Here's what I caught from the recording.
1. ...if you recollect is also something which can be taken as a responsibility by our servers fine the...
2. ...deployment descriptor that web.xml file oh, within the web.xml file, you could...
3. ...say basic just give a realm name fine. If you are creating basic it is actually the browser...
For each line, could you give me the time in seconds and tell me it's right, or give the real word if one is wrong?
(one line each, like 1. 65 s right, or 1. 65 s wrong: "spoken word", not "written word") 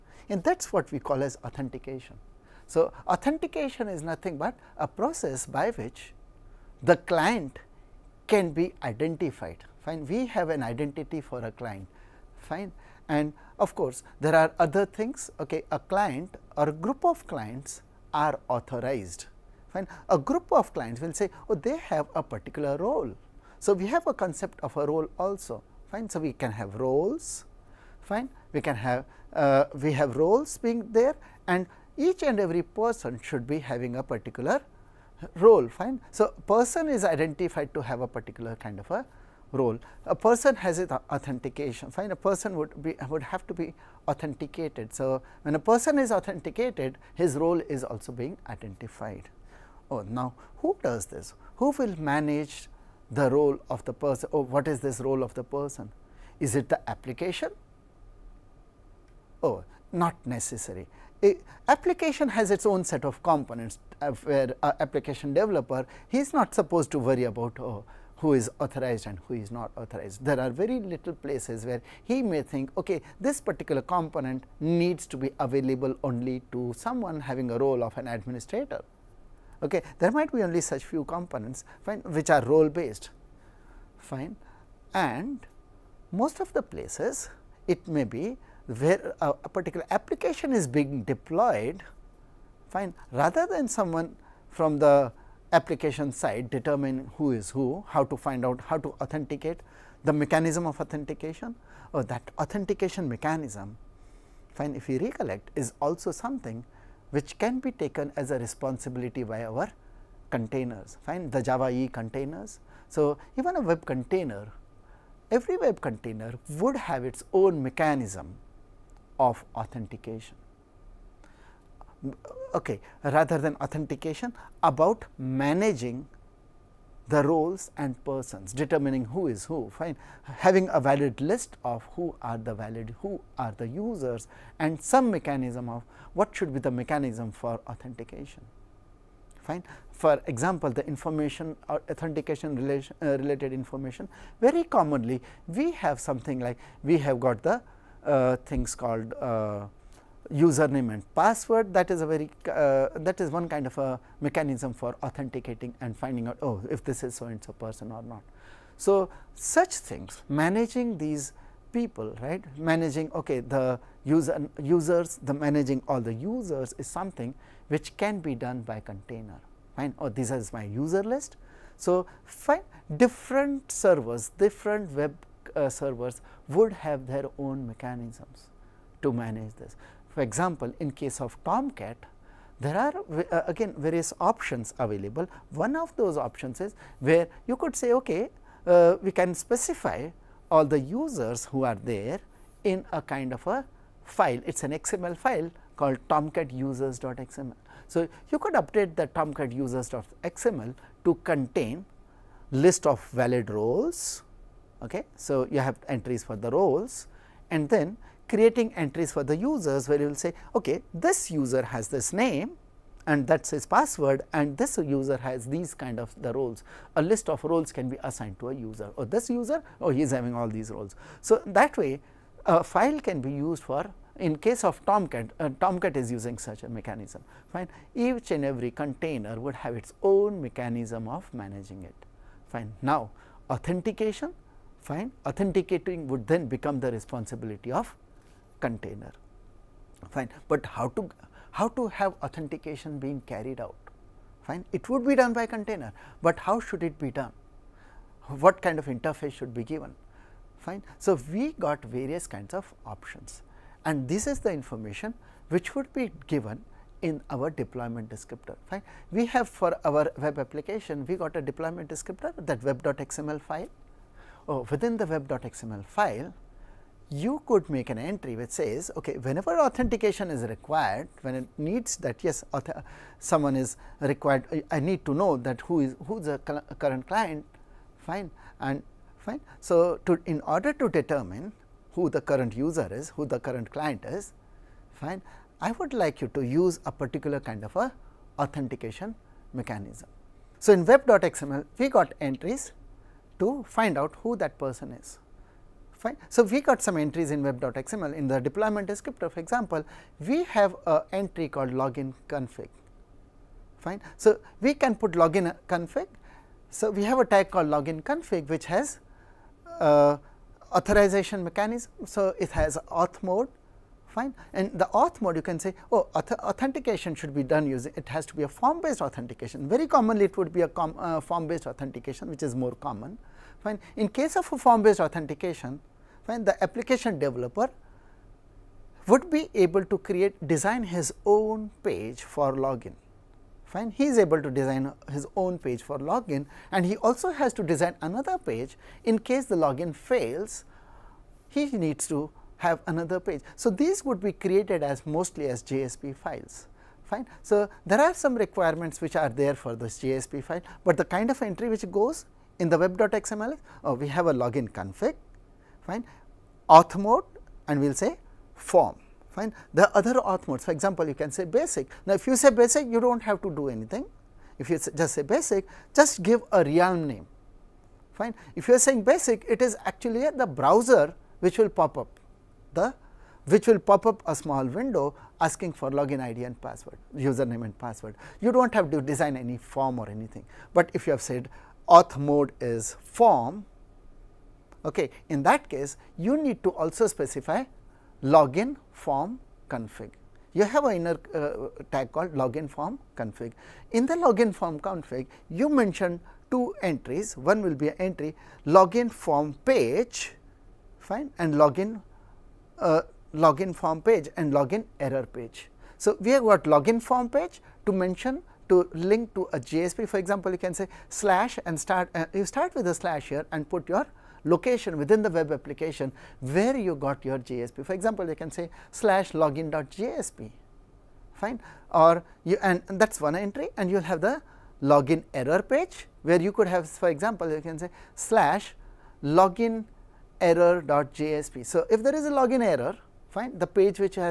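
1. 104 s wrong: "containers", not "servers"
2. 261 s right
3. 365 s wrong: "saying", not "creating".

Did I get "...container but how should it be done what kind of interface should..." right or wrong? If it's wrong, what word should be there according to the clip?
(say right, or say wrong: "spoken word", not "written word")
right.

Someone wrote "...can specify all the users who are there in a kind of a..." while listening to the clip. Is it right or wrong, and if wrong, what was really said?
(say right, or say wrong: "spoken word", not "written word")
right.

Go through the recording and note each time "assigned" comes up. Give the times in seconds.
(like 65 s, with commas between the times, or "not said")
218 s.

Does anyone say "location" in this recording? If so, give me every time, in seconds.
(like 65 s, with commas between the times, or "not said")
414 s.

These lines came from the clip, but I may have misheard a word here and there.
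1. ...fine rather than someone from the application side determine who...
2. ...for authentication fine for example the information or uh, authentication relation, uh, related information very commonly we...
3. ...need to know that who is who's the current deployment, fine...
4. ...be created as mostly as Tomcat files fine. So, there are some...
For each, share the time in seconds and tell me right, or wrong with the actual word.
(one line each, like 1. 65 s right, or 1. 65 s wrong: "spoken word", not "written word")
1. 92 s right
2. 137 s right
3. 274 s wrong: "client", not "deployment"
4. 344 s wrong: "JSP", not "Tomcat".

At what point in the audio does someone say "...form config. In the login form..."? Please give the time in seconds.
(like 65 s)
392 s.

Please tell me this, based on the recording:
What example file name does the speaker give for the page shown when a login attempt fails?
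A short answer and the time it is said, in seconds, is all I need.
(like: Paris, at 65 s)
login error.jsp, at 429 s.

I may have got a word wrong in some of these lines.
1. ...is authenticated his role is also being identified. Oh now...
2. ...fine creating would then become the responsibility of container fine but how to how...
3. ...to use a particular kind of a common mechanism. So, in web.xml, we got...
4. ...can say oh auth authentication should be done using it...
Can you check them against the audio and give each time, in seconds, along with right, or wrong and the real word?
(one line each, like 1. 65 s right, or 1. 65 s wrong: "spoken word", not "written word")
1. 45 s right
2. 234 s wrong: "authenticating", not "creating"
3. 286 s wrong: "authentication", not "common"
4. 315 s right.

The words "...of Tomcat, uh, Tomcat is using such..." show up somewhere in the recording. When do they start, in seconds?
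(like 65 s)
224 s.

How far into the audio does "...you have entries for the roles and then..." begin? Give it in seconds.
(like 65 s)
205 s.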